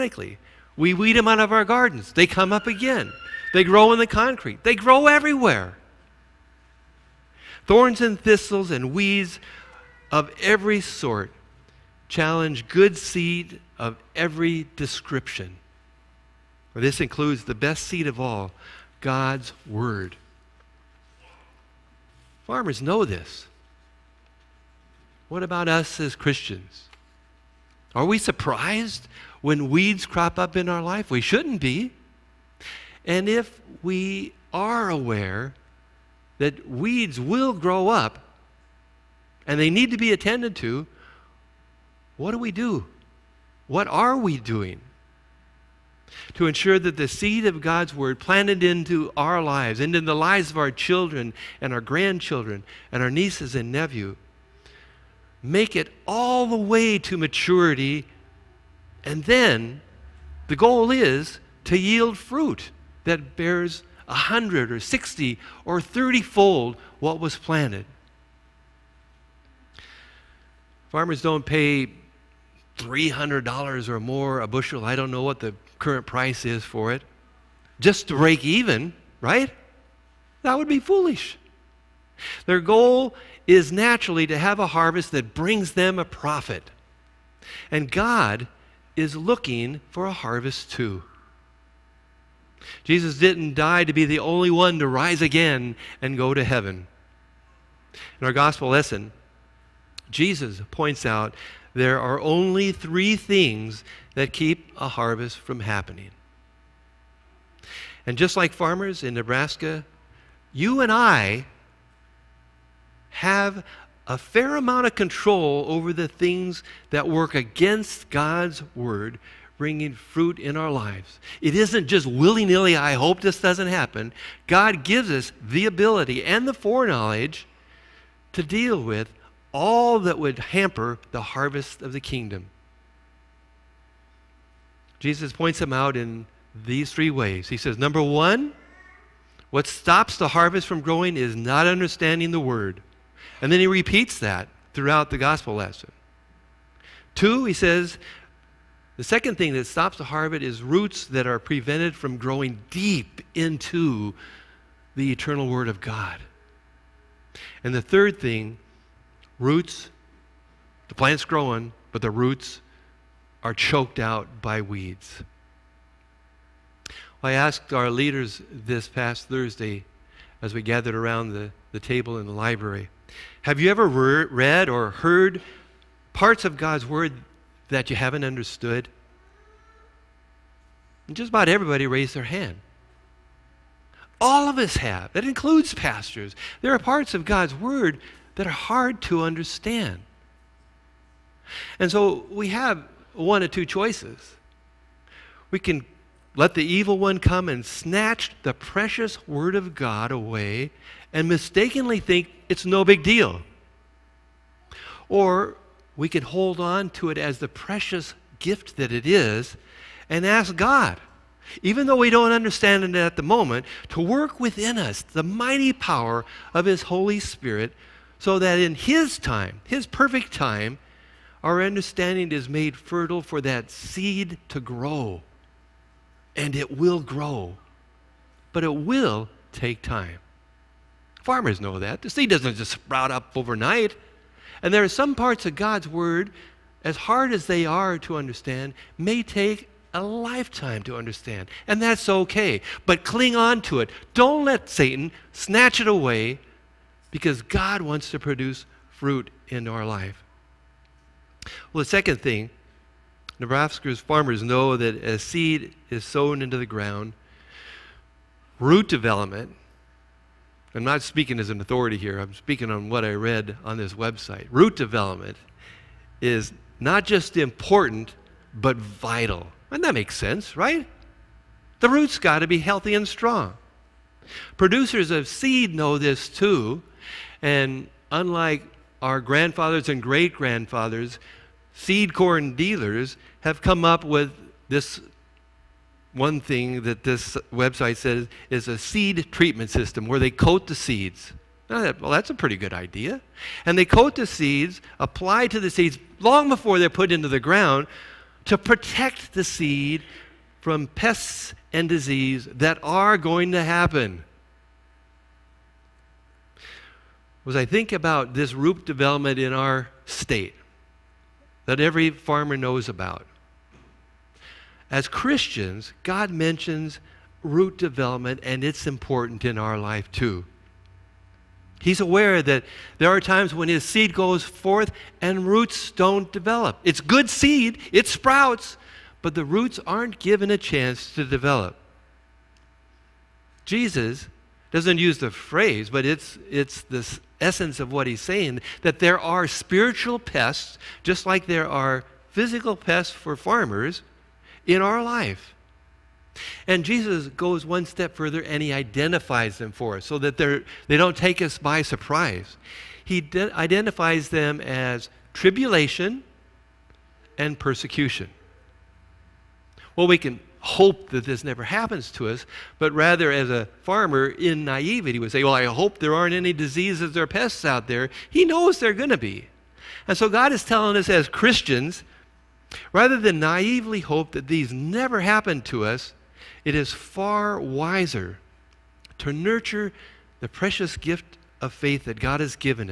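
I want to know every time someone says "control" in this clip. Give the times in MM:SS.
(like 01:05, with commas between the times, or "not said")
01:54.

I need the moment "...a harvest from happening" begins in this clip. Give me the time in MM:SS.
01:44.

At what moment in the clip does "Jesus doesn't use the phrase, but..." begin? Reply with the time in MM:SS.
05:33.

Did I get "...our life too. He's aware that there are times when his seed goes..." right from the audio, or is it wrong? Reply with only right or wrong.
right.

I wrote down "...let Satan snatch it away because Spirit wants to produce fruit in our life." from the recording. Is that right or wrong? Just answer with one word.
wrong.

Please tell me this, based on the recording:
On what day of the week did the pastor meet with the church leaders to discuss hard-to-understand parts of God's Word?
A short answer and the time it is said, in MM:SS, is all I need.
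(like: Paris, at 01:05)
Thursday, at 02:49.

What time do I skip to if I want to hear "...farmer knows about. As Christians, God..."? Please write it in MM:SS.
05:12.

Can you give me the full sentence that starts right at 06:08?
He knows they're going to be.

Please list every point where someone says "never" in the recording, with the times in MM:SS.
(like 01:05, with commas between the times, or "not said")
06:01, 06:14.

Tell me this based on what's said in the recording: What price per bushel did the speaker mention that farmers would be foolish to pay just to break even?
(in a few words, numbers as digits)
$300.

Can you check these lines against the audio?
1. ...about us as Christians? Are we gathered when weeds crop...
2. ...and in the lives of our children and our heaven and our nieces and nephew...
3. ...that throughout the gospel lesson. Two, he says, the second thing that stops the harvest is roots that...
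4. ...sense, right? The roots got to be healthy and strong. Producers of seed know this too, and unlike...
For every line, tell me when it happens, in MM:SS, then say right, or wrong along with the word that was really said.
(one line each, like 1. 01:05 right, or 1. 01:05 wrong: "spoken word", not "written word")
1. 00:25 wrong: "surprised", not "gathered"
2. 00:49 wrong: "grandchildren", not "heaven"
3. 02:24 right
4. 04:30 right.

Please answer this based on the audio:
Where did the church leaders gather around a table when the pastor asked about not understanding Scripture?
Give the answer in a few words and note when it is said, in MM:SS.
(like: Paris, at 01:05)
the library, at 02:52.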